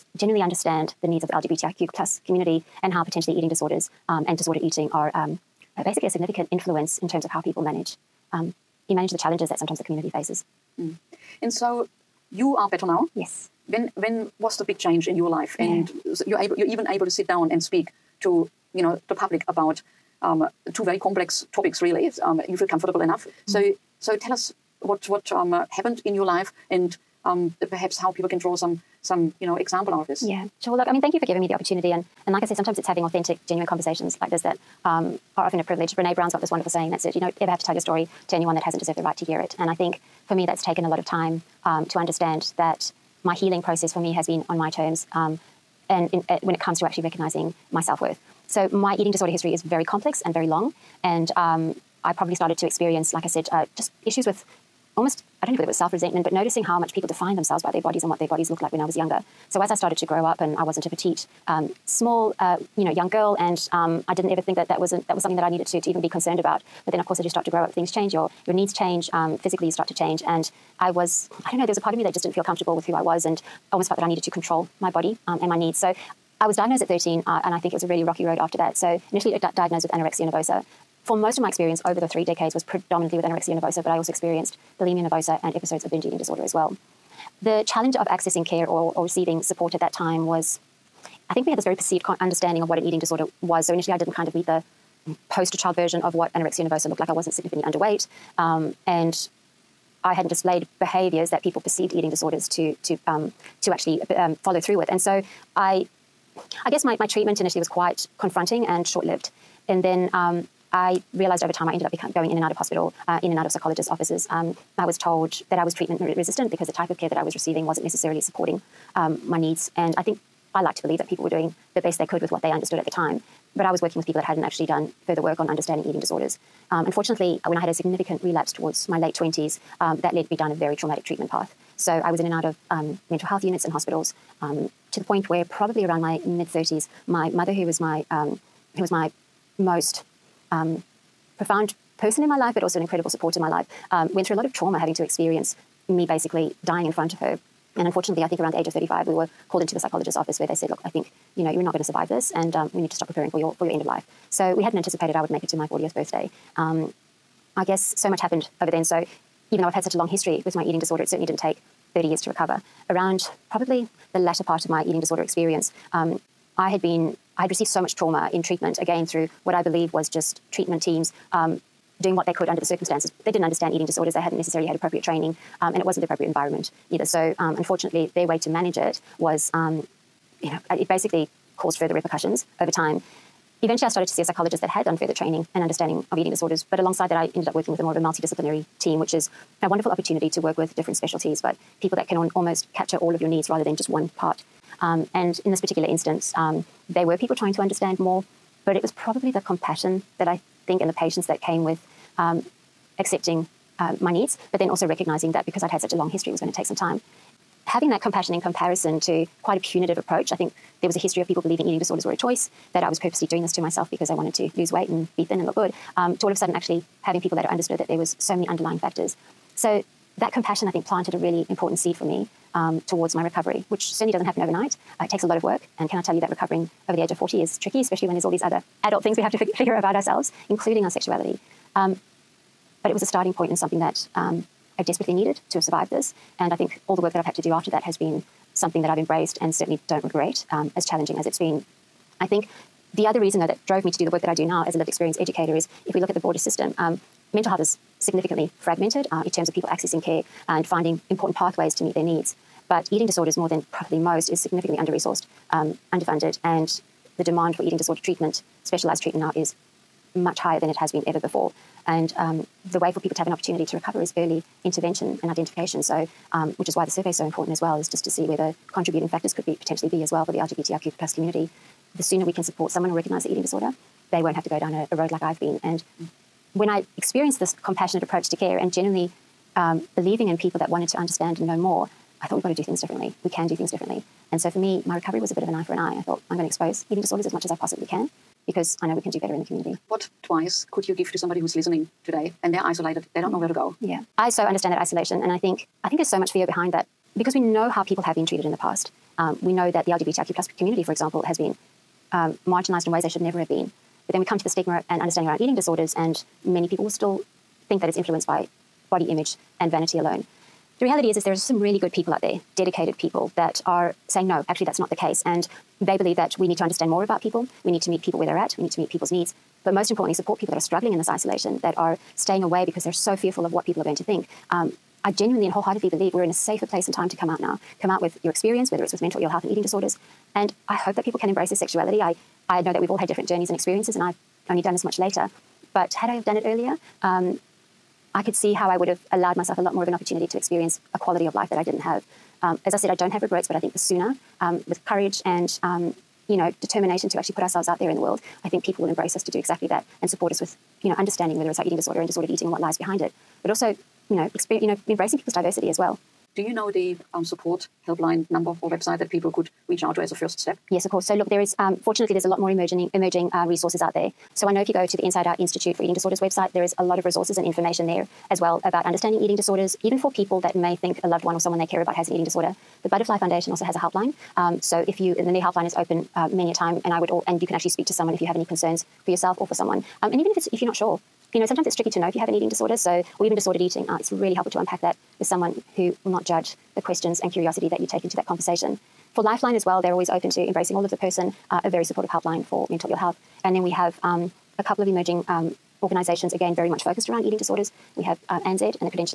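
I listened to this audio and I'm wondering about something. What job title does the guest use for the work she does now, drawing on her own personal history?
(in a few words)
lived experience educator.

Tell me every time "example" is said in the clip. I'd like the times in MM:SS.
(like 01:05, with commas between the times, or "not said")
00:29, 05:00.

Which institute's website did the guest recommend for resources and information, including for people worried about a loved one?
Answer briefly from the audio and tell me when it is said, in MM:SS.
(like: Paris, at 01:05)
Inside Out Institute, at 06:05.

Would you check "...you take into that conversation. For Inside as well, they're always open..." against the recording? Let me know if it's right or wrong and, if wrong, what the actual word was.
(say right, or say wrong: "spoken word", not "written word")
wrong: "Lifeline", not "Inside".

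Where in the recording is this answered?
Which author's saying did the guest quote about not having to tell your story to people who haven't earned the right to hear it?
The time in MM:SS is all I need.
00:35.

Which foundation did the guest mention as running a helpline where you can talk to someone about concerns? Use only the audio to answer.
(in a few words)
Butterfly Foundation.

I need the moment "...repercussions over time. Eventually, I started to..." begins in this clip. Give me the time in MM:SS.
03:01.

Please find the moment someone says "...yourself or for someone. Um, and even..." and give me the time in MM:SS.
06:19.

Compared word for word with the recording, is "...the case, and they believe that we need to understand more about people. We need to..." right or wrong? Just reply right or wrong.
right.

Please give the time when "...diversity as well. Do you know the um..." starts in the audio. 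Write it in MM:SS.
05:55.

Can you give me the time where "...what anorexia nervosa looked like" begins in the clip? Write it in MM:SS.
01:36.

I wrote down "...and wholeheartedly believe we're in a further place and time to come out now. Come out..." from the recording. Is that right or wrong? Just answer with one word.
wrong.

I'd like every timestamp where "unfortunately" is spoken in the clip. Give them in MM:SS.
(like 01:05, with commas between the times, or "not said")
02:06, 02:27, 02:57.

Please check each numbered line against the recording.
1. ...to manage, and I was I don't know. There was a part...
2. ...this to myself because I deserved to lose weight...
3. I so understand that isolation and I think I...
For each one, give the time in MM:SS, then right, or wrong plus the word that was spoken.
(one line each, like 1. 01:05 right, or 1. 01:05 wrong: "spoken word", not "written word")
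1. 01:09 wrong: "change", not "manage"
2. 03:33 wrong: "wanted", not "deserved"
3. 04:54 right.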